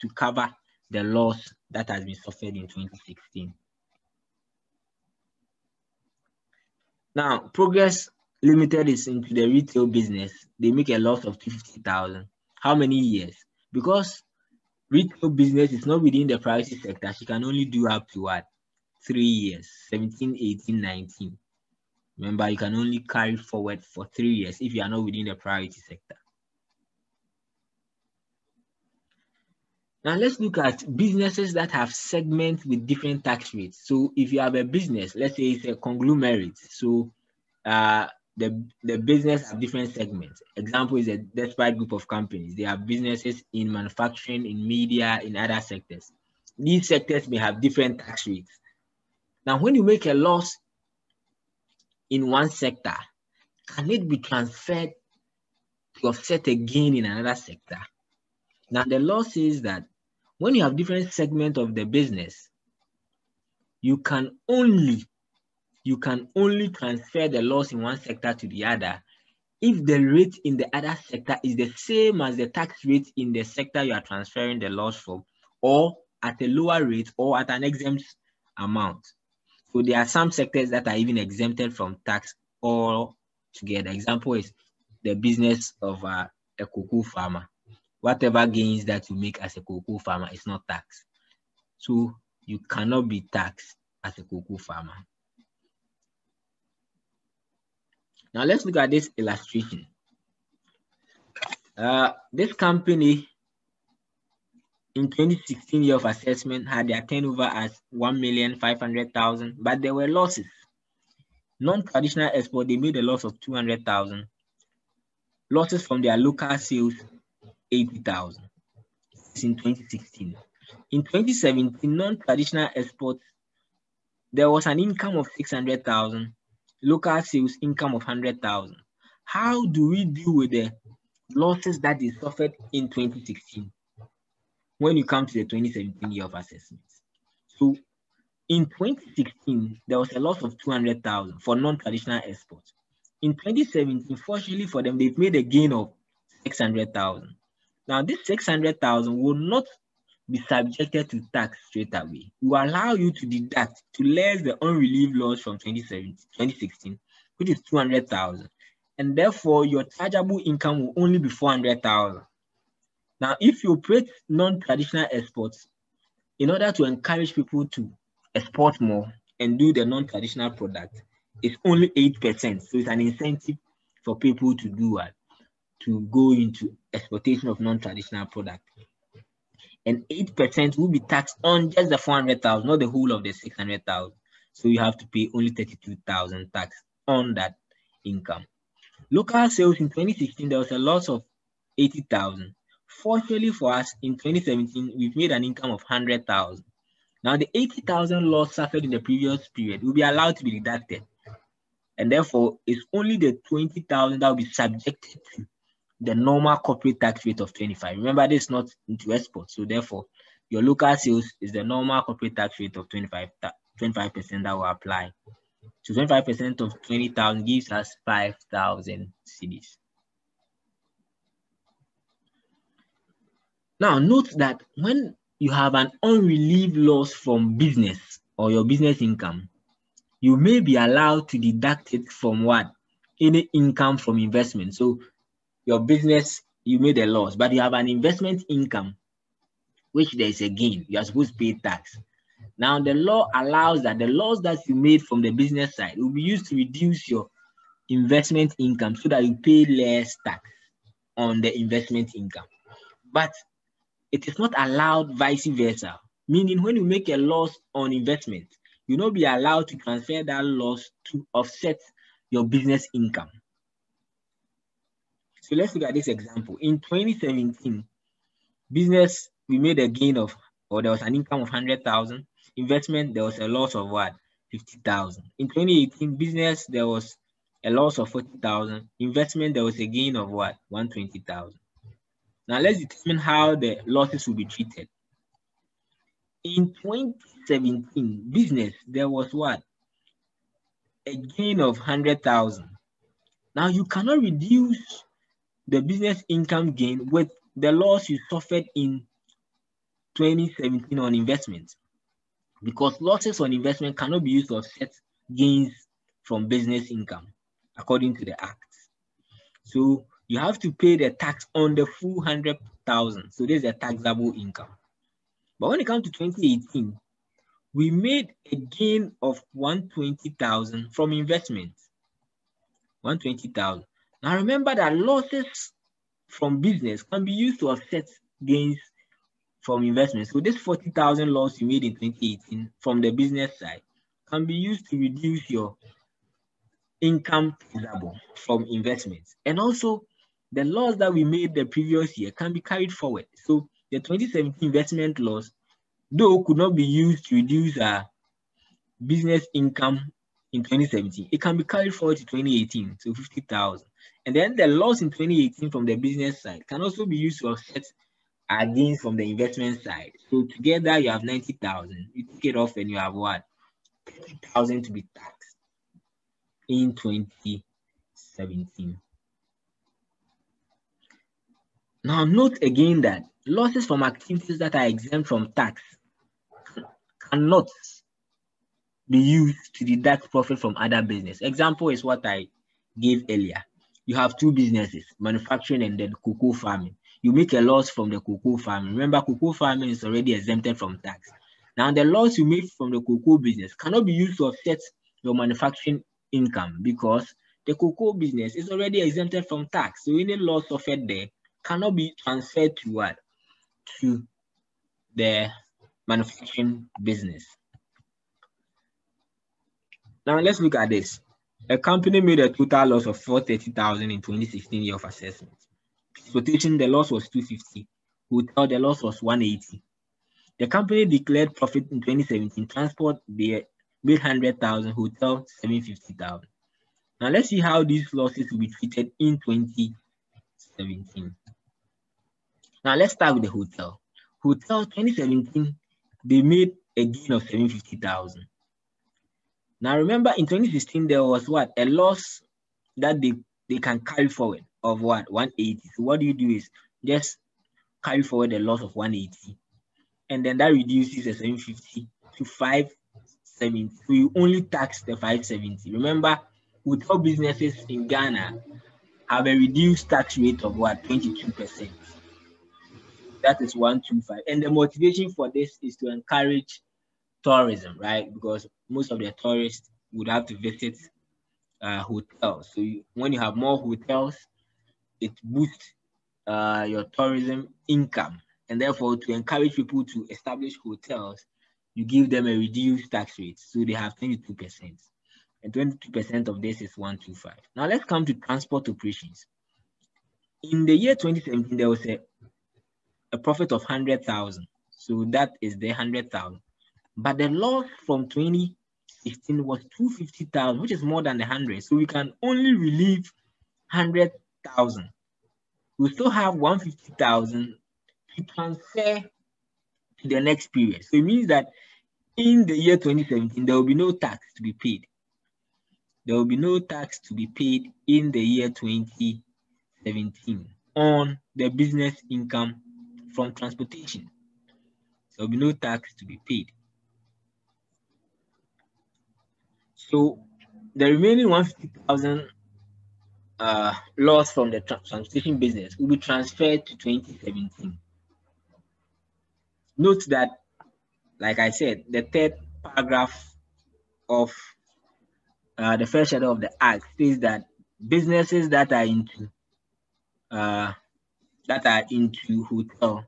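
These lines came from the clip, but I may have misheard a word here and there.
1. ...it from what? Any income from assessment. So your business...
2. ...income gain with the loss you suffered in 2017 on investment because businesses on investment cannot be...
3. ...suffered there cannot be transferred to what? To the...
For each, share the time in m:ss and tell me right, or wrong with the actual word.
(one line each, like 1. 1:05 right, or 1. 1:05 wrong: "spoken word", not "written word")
1. 3:51 wrong: "investment", not "assessment"
2. 4:56 wrong: "losses", not "businesses"
3. 6:40 right.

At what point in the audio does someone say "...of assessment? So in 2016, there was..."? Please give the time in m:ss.
2:16.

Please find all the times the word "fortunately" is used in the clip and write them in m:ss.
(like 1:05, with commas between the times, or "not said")
2:24, 3:12.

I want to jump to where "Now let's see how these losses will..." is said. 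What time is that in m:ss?
7:07.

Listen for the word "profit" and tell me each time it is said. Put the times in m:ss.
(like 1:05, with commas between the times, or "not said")
6:20, 7:01, 8:13.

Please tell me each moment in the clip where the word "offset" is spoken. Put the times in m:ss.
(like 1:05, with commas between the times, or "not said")
0:56, 4:21, 5:04, 5:27, 5:57, 6:34.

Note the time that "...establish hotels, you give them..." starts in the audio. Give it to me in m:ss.
8:00.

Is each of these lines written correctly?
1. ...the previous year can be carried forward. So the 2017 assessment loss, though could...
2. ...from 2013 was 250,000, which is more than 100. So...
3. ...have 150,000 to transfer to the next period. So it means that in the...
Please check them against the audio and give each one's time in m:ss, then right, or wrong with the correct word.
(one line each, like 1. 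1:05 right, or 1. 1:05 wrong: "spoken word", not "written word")
1. 5:41 wrong: "investment", not "assessment"
2. 8:18 wrong: "2016", not "2013"
3. 8:26 right.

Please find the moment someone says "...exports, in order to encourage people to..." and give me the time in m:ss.
2:45.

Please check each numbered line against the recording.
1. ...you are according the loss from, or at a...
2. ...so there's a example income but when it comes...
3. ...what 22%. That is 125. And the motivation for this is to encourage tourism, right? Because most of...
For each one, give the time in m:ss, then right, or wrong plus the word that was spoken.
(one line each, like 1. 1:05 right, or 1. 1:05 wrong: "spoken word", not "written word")
1. 1:13 wrong: "transferring", not "according"
2. 5:13 wrong: "taxable", not "example"
3. 7:40 right.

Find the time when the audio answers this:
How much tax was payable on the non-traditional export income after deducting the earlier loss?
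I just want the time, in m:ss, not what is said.
3:05.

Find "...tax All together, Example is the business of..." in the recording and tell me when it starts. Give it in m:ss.
1:22.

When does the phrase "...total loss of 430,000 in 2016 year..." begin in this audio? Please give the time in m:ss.
6:52.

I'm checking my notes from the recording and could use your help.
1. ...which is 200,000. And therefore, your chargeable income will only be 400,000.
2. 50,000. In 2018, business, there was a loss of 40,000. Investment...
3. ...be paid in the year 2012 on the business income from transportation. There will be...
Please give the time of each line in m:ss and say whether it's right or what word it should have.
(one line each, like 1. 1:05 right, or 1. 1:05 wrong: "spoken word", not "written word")
1. 2:37 right
2. 4:34 right
3. 8:37 wrong: "2017", not "2012".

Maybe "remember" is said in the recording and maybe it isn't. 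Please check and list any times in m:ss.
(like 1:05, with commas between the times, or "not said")
0:22, 3:27, 5:24, 6:28, 7:19, 7:35.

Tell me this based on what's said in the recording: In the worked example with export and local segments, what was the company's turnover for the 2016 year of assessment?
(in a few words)
1,500,000.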